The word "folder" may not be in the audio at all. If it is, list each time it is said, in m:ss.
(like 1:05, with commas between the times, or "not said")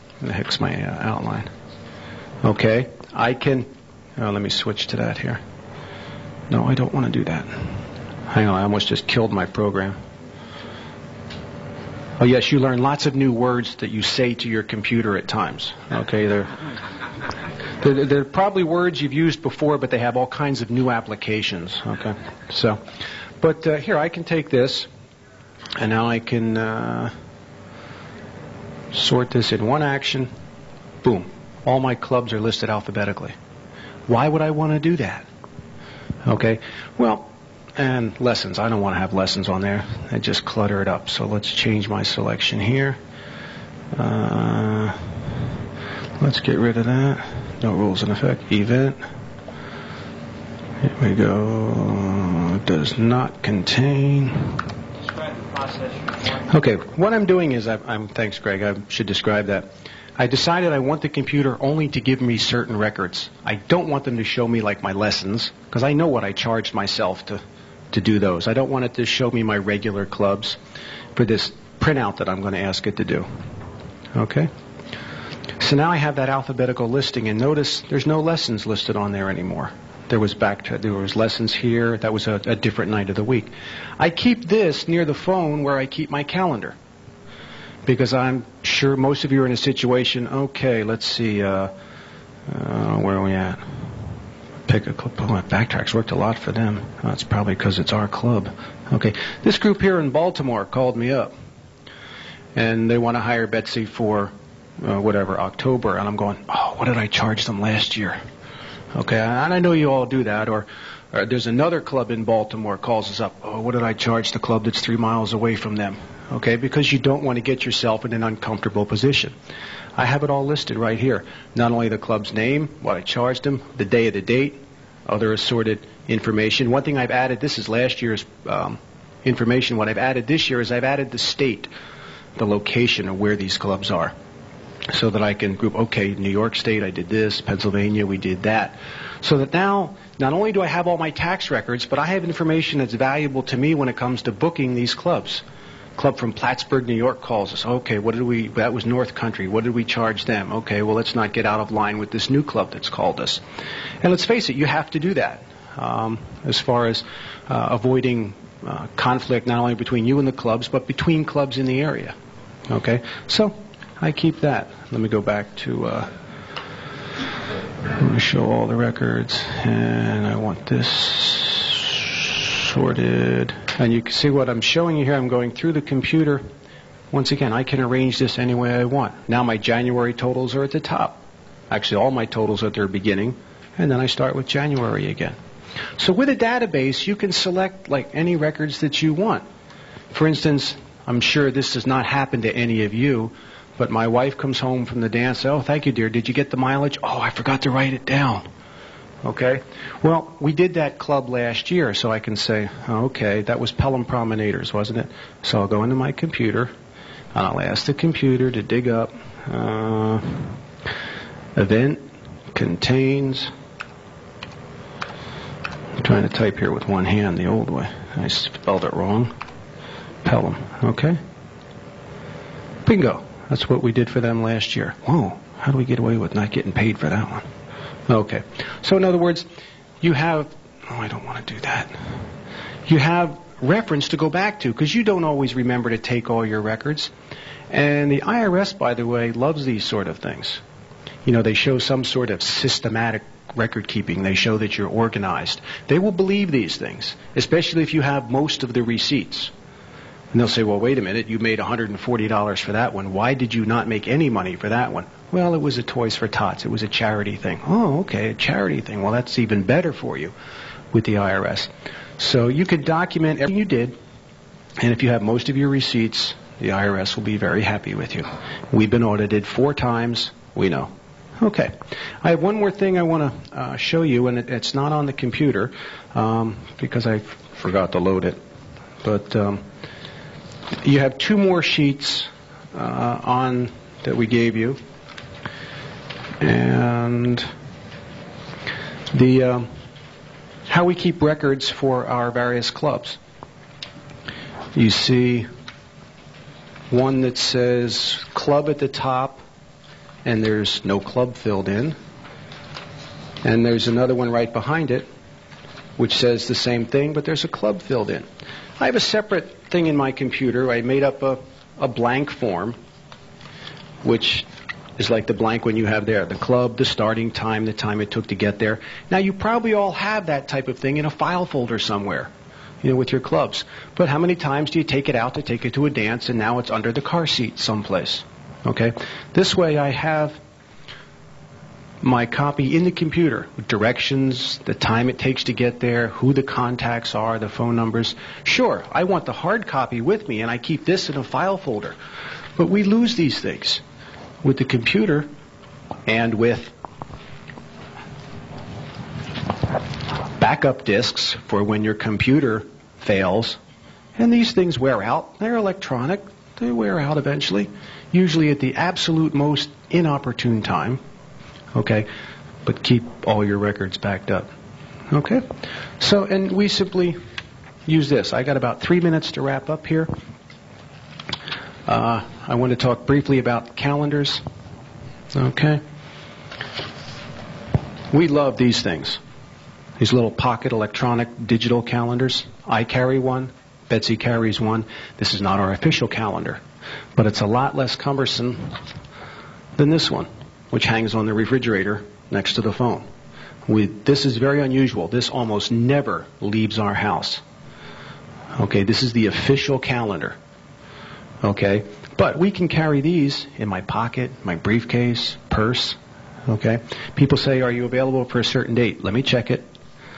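5:21, 5:41.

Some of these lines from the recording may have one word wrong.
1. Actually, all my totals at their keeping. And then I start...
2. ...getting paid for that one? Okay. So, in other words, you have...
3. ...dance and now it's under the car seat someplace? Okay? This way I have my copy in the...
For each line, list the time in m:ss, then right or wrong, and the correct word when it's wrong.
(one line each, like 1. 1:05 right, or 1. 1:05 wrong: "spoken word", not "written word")
1. 3:01 wrong: "beginning", not "keeping"
2. 3:46 right
3. 5:25 right.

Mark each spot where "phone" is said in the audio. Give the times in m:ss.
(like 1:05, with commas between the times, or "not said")
1:25, 5:37, 6:32.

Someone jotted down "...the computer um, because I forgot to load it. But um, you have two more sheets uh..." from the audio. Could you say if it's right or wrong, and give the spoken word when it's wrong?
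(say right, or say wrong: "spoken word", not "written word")
right.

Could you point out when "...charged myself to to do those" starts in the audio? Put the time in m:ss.
1:06.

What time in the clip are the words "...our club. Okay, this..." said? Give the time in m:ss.
1:37.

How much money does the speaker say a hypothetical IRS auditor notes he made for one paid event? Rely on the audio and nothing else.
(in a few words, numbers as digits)
$140.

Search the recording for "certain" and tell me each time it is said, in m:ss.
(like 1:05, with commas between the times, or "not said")
1:02, 6:48.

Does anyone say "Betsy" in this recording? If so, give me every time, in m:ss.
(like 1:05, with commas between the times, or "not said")
1:43, 6:23.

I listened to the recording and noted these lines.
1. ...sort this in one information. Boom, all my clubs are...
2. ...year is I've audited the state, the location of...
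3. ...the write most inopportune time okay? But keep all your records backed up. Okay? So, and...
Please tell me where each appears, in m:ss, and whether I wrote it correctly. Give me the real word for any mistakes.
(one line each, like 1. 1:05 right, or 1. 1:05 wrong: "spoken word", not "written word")
1. 0:28 wrong: "action", not "information"
2. 2:10 wrong: "added", not "audited"
3. 5:58 wrong: "absolute", not "write".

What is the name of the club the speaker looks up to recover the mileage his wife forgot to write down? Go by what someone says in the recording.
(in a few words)
Pelham Promenaders.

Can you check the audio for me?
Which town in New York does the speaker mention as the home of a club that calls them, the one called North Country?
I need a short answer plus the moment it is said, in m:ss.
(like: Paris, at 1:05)
Plattsburgh, at 2:26.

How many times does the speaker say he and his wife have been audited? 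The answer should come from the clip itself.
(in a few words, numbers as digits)
4.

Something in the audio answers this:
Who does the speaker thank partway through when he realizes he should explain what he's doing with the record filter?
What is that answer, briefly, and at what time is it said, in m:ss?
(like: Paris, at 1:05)
Gregg, at 0:58.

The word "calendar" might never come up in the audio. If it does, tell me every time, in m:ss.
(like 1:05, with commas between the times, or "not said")
1:26, 6:13, 6:21, 6:26, 6:39.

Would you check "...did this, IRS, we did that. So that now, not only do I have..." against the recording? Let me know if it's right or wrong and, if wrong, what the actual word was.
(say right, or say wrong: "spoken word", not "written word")
wrong: "Pennsylvania", not "IRS".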